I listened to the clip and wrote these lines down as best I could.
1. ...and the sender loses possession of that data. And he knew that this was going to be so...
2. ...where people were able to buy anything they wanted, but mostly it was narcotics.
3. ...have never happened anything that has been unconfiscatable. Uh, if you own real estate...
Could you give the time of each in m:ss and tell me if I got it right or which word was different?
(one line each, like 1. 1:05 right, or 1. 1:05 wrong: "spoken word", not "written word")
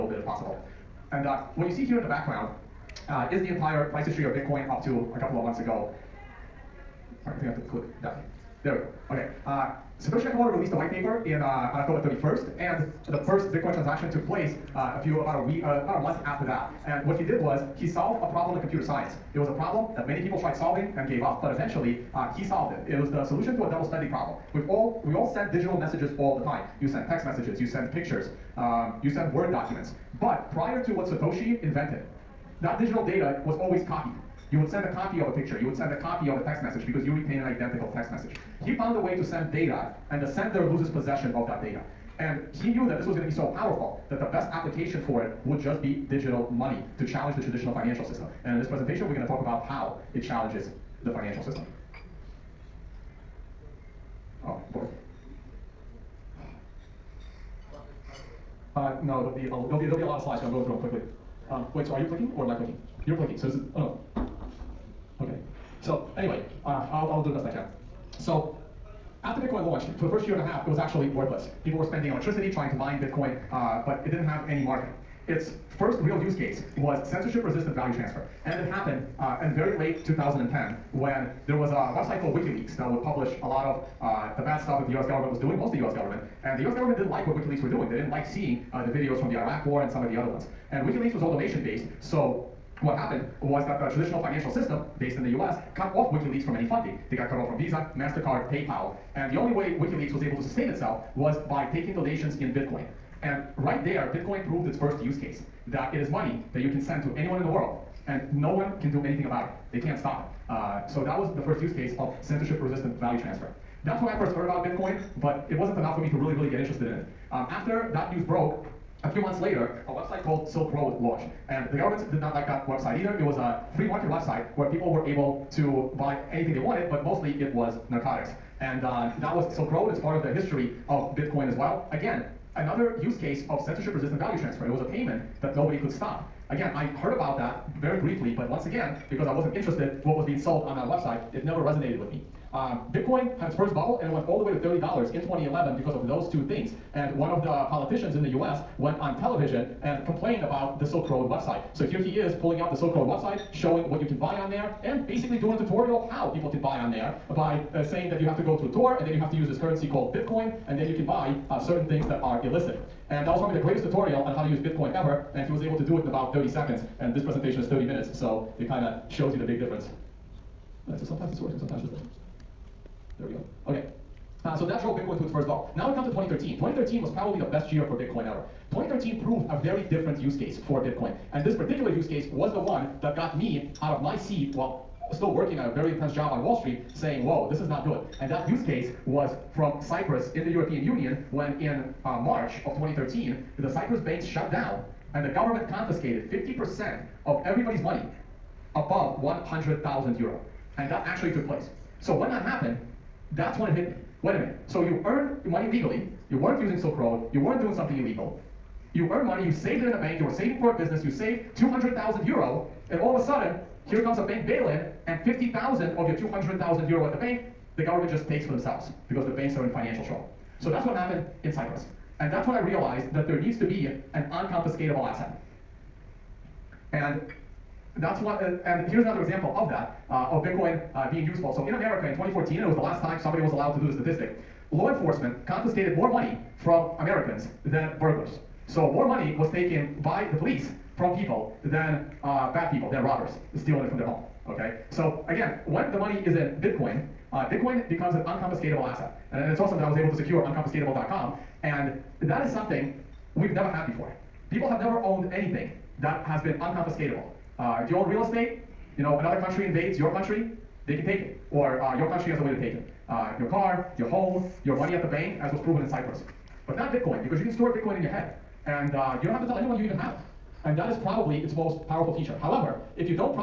1. 0:40 right
2. 2:04 right
3. 4:14 wrong: "owned", not "happened".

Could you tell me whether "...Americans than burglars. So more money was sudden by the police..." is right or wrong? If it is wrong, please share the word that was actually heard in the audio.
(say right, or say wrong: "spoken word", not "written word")
wrong: "taken", not "sudden".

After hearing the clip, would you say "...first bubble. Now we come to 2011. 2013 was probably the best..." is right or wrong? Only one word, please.
wrong.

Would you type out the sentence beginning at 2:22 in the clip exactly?
Uh, Bitcoin had its first bubble and it went all the way to $30 in 2011 because of those two things.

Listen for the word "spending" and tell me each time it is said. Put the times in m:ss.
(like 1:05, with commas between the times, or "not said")
0:23, 1:11.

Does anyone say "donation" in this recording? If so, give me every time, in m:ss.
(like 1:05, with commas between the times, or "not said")
1:31, 1:41.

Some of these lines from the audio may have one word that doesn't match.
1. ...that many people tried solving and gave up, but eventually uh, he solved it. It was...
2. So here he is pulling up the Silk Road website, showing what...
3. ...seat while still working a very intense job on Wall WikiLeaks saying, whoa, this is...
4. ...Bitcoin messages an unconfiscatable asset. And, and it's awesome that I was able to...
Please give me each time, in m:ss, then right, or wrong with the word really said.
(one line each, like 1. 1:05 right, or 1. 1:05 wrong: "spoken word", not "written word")
1. 0:19 right
2. 2:31 right
3. 3:04 wrong: "Street", not "WikiLeaks"
4. 4:07 wrong: "becomes", not "messages".